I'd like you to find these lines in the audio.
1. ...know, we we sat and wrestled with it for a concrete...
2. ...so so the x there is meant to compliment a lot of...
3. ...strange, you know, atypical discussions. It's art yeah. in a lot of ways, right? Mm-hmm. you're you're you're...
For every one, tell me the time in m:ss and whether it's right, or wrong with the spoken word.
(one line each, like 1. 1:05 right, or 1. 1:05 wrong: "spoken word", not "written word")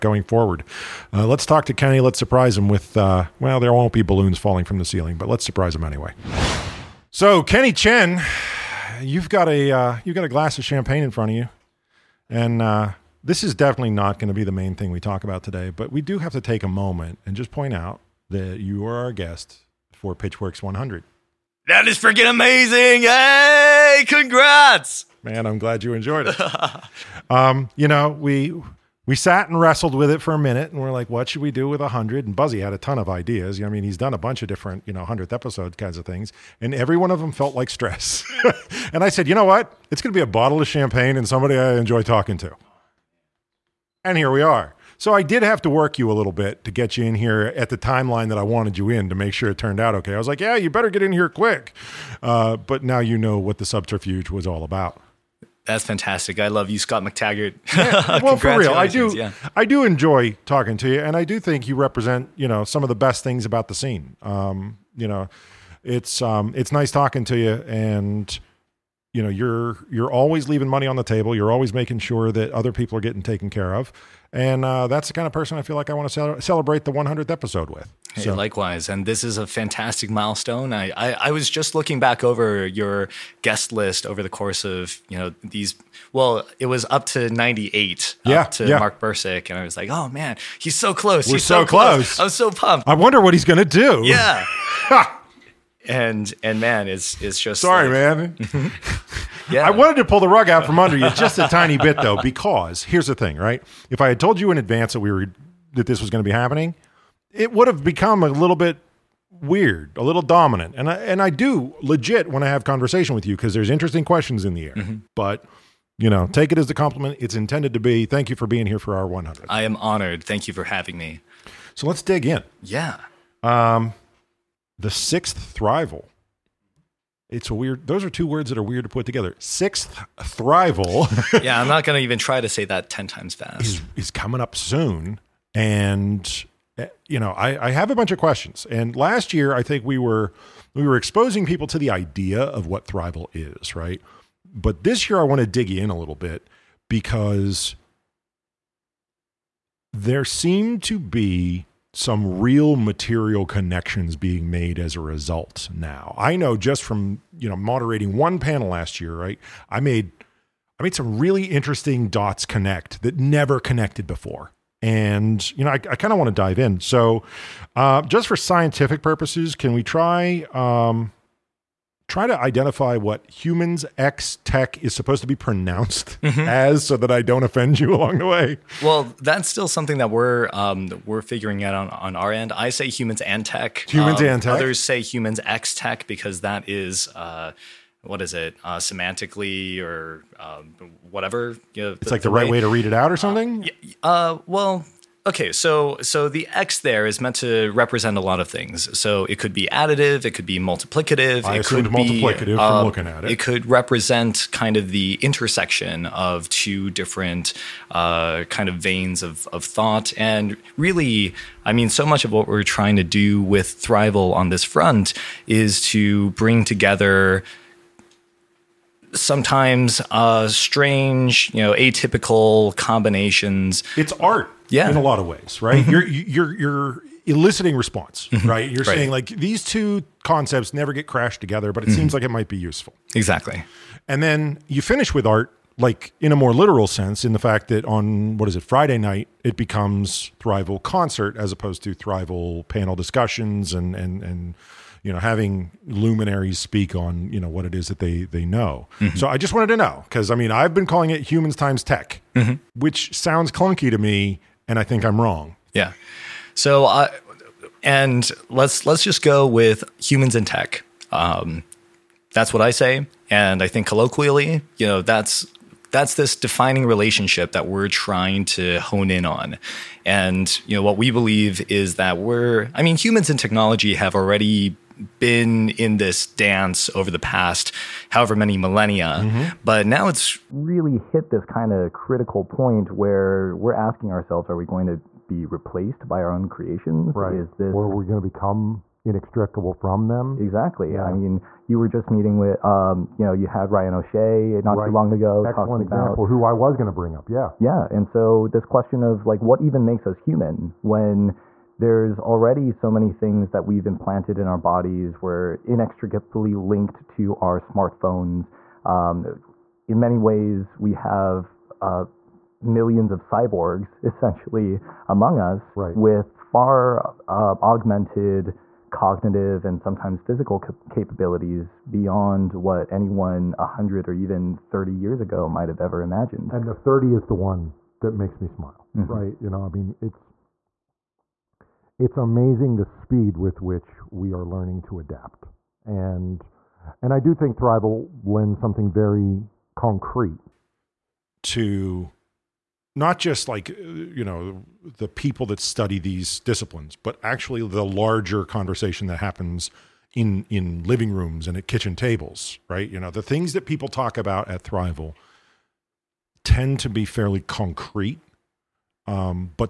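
1. 0:27 wrong: "minute", not "concrete"
2. 3:15 wrong: "represent", not "compliment"
3. 3:40 wrong: "combinations", not "discussions".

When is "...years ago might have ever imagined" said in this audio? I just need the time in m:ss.
5:24.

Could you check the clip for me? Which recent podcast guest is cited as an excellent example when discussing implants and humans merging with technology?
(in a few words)
Ryan O'Shea.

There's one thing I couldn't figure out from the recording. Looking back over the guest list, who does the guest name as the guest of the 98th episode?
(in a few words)
Mark Bursick.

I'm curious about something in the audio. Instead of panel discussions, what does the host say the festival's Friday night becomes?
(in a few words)
Thrival concert.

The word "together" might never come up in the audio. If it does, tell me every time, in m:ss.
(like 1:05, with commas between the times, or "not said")
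2:09, 3:36, 3:51.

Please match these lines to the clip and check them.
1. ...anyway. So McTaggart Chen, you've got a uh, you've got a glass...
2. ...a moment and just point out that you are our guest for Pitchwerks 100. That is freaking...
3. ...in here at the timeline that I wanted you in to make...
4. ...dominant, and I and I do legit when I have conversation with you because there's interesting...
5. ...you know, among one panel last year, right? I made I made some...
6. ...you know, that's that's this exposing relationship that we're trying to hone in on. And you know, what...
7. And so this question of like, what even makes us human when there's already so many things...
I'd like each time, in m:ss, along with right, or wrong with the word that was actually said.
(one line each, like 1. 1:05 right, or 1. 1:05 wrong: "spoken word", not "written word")
1. 0:05 wrong: "Kenny", not "McTaggart"
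2. 0:16 right
3. 0:47 right
4. 1:50 right
5. 2:37 wrong: "moderating", not "among"
6. 4:24 wrong: "defining", not "exposing"
7. 4:57 right.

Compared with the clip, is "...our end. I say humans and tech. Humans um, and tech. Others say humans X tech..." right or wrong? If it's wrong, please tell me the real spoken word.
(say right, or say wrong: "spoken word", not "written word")
right.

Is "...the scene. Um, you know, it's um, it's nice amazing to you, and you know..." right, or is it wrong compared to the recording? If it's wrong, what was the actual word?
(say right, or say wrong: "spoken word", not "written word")
wrong: "talking", not "amazing".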